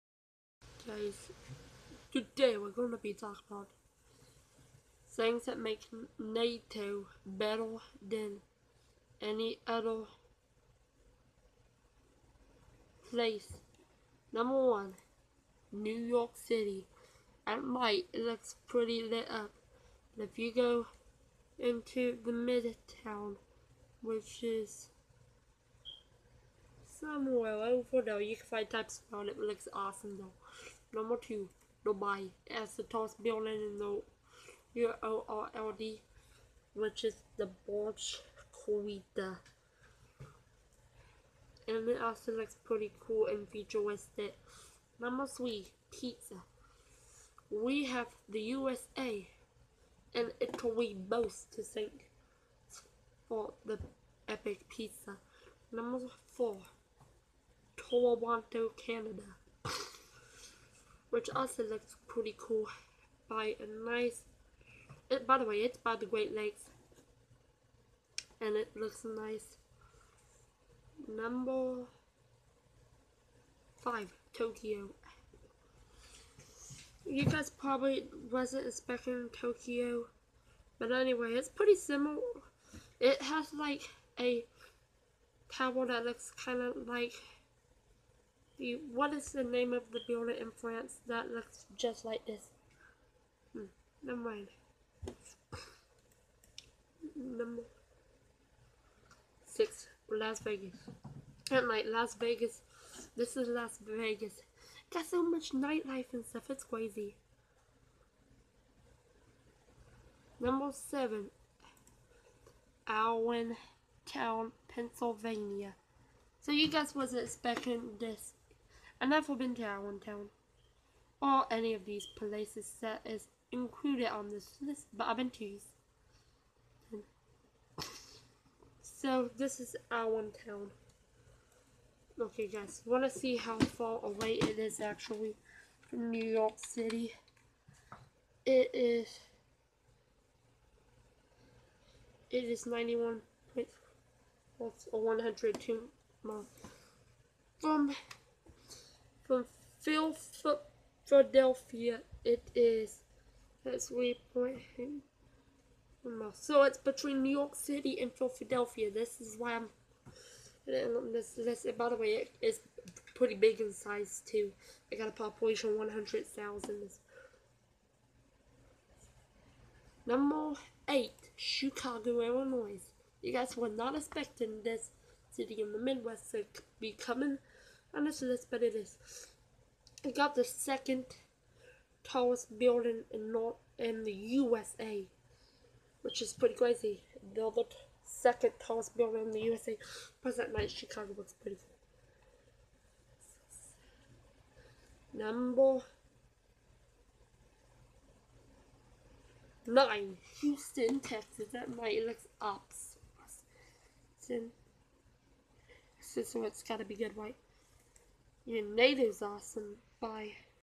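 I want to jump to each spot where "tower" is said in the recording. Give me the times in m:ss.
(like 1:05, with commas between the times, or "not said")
1:25.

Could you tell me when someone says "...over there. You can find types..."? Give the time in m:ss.
0:27.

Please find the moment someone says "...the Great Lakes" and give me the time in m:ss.
1:05.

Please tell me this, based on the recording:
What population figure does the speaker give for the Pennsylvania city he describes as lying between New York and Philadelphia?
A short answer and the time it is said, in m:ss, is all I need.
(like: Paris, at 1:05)
100,000, at 2:45.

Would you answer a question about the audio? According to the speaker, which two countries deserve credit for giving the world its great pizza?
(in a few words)
USA and Italy.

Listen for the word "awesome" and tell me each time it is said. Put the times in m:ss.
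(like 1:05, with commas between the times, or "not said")
0:29, 3:22, 3:29.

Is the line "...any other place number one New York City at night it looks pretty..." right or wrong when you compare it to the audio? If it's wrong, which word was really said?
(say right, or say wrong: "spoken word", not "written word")
right.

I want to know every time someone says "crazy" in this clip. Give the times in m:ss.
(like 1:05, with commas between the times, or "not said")
1:46, 3:06.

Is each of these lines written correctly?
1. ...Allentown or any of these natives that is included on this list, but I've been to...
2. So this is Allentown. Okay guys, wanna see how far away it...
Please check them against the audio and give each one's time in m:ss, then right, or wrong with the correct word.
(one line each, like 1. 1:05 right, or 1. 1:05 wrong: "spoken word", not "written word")
1. 1:59 wrong: "places", not "natives"
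2. 2:08 right.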